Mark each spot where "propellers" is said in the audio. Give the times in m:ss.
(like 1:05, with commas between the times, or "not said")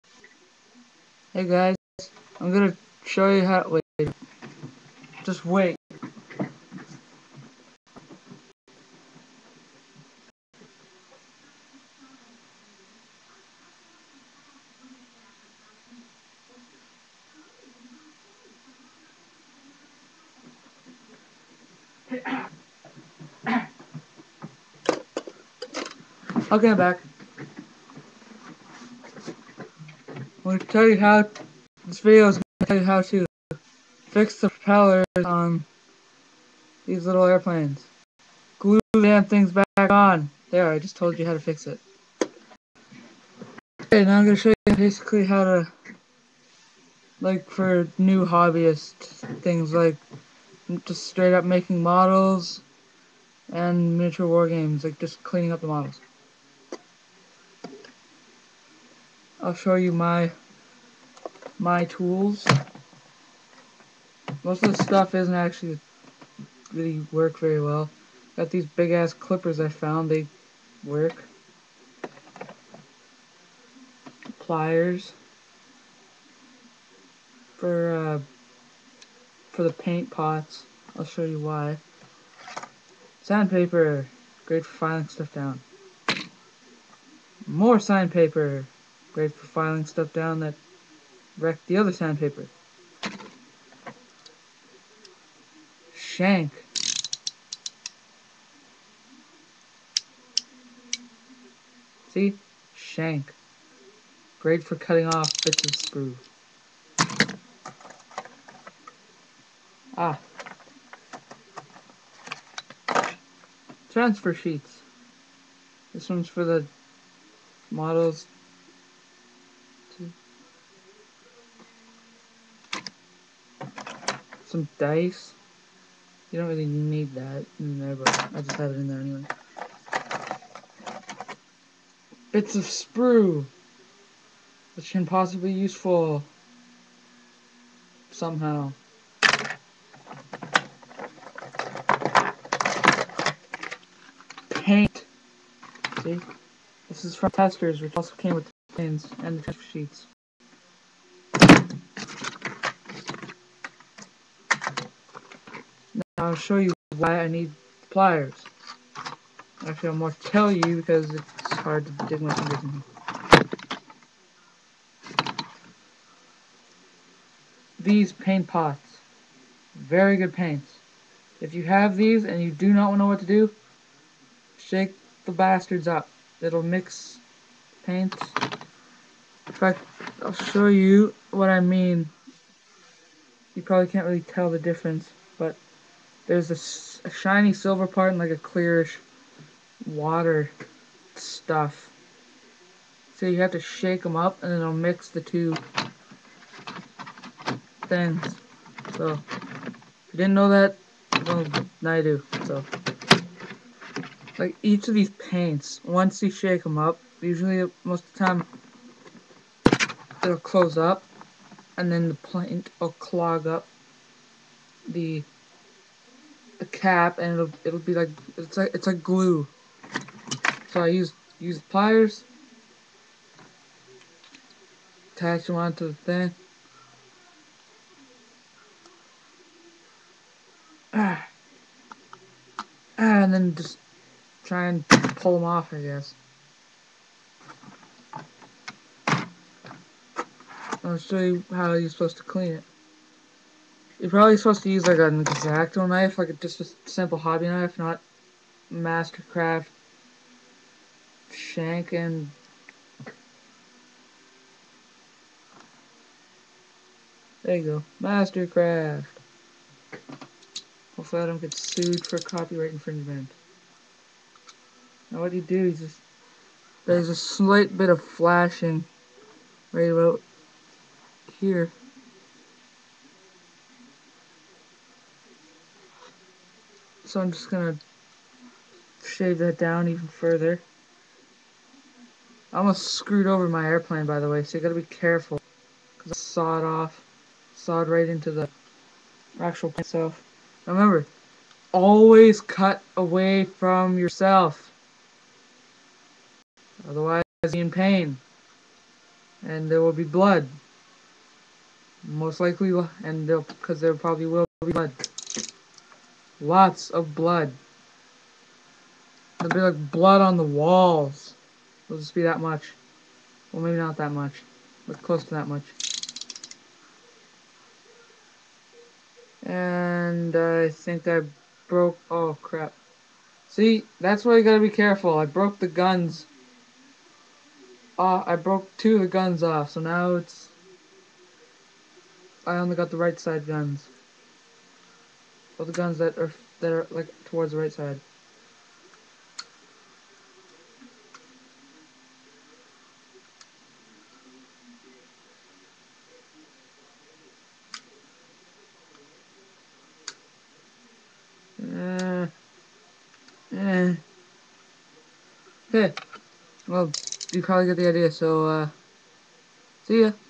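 0:34.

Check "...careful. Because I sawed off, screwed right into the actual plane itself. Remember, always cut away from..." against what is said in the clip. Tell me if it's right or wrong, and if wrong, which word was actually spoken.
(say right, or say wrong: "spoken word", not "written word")
wrong: "sawed", not "screwed".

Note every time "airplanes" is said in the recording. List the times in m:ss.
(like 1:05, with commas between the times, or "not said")
0:37, 4:43.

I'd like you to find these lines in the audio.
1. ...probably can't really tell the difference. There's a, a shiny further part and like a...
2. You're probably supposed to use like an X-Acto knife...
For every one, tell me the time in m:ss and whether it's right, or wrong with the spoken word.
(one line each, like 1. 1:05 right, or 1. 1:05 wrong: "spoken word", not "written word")
1. 3:03 wrong: "silver", not "further"
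2. 4:04 right.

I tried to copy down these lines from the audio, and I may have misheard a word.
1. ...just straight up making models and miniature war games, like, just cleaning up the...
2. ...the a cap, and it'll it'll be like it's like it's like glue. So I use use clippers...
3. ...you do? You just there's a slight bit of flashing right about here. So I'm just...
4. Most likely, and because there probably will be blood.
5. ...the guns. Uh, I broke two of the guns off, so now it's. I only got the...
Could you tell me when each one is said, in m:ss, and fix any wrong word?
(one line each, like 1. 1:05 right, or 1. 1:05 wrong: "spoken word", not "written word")
1. 0:50 right
2. 3:34 wrong: "pliers", not "clippers"
3. 4:25 right
4. 5:02 right
5. 5:25 right.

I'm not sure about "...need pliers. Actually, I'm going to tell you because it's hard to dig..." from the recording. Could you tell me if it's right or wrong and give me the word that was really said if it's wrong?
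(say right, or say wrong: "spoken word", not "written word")
right.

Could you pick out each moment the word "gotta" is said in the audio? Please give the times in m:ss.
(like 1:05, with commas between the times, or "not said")
4:44, 5:24.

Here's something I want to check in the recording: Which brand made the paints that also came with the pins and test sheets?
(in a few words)
Testors.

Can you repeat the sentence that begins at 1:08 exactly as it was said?
Got these big ass clippers I found, they work.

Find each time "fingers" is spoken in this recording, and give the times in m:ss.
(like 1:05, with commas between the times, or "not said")
2:42.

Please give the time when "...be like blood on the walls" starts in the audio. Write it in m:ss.
5:09.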